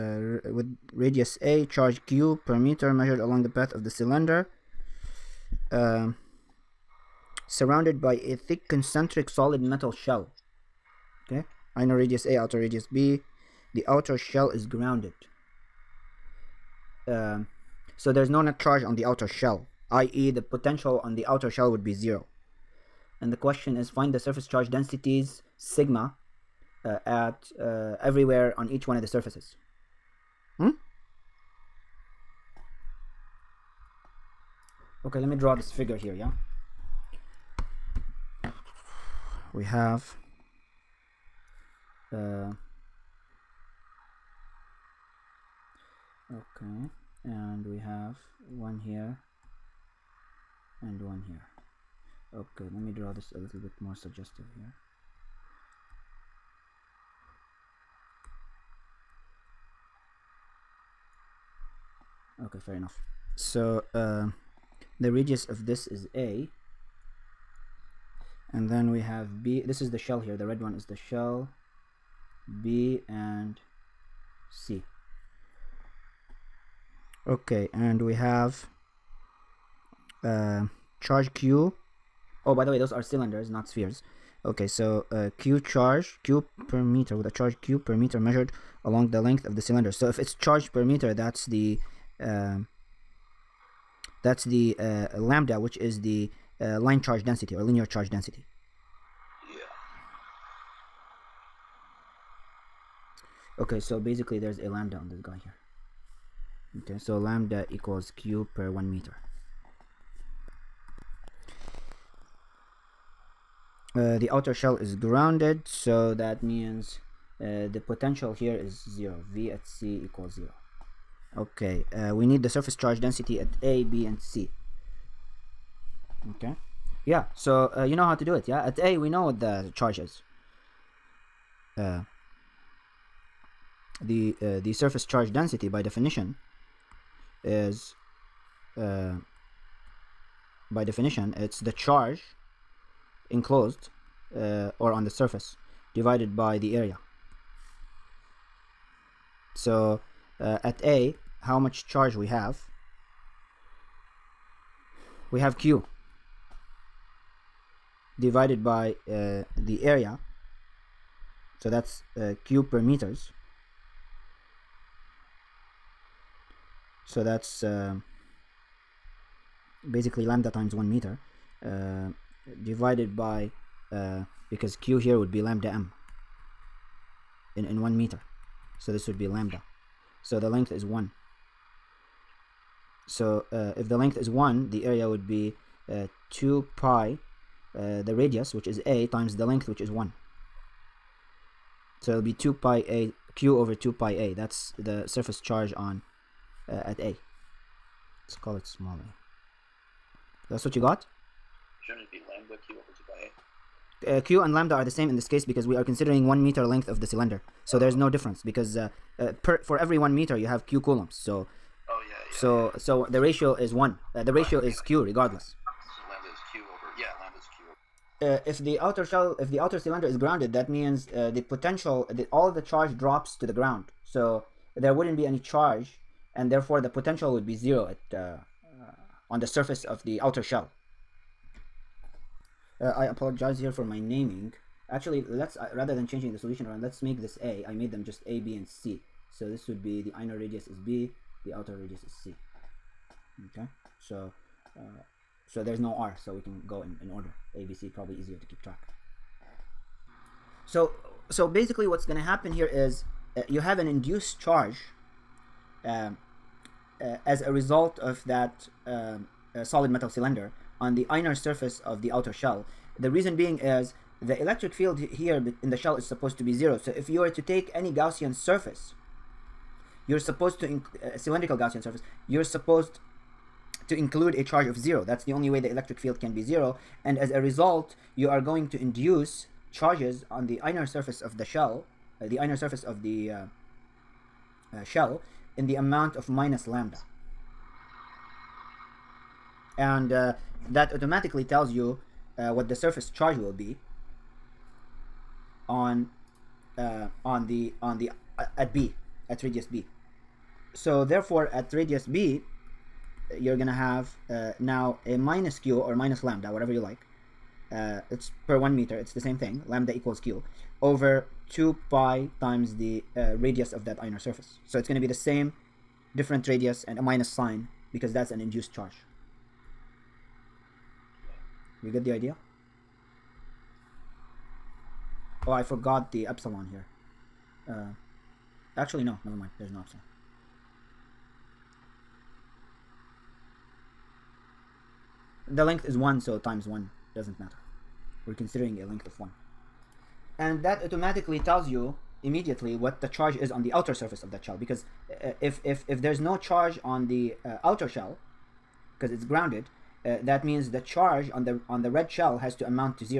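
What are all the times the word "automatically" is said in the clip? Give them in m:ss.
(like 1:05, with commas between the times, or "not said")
4:50, 5:40.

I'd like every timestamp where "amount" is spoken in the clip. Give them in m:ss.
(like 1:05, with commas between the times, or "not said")
4:45, 5:52.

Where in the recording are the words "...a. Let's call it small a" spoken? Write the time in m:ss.
3:16.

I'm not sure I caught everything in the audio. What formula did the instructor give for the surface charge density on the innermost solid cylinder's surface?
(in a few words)
q over 2 pi a.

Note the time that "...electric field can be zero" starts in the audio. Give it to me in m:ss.
4:35.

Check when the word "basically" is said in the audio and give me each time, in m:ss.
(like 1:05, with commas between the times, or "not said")
1:43, 2:49, 4:11.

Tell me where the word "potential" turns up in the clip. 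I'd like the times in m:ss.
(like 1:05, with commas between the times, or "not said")
0:20, 1:57, 3:41, 3:46.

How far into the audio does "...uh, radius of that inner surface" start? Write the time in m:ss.
5:13.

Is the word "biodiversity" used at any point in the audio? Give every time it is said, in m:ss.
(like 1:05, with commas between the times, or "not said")
not said.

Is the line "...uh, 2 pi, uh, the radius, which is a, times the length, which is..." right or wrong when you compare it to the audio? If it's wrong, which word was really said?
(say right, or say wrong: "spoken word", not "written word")
right.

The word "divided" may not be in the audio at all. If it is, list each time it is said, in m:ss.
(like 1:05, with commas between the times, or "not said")
2:25, 2:38, 2:52.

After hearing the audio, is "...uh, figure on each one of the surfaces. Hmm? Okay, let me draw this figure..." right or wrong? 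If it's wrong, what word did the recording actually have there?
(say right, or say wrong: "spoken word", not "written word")
wrong: "everywhere", not "figure".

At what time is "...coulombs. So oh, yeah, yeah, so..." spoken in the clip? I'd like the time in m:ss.
3:30.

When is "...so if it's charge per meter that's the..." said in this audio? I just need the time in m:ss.
1:29.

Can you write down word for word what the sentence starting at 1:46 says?
Okay, so lambda equals q per one meter.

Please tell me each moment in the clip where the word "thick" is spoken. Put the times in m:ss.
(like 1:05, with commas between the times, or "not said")
0:08.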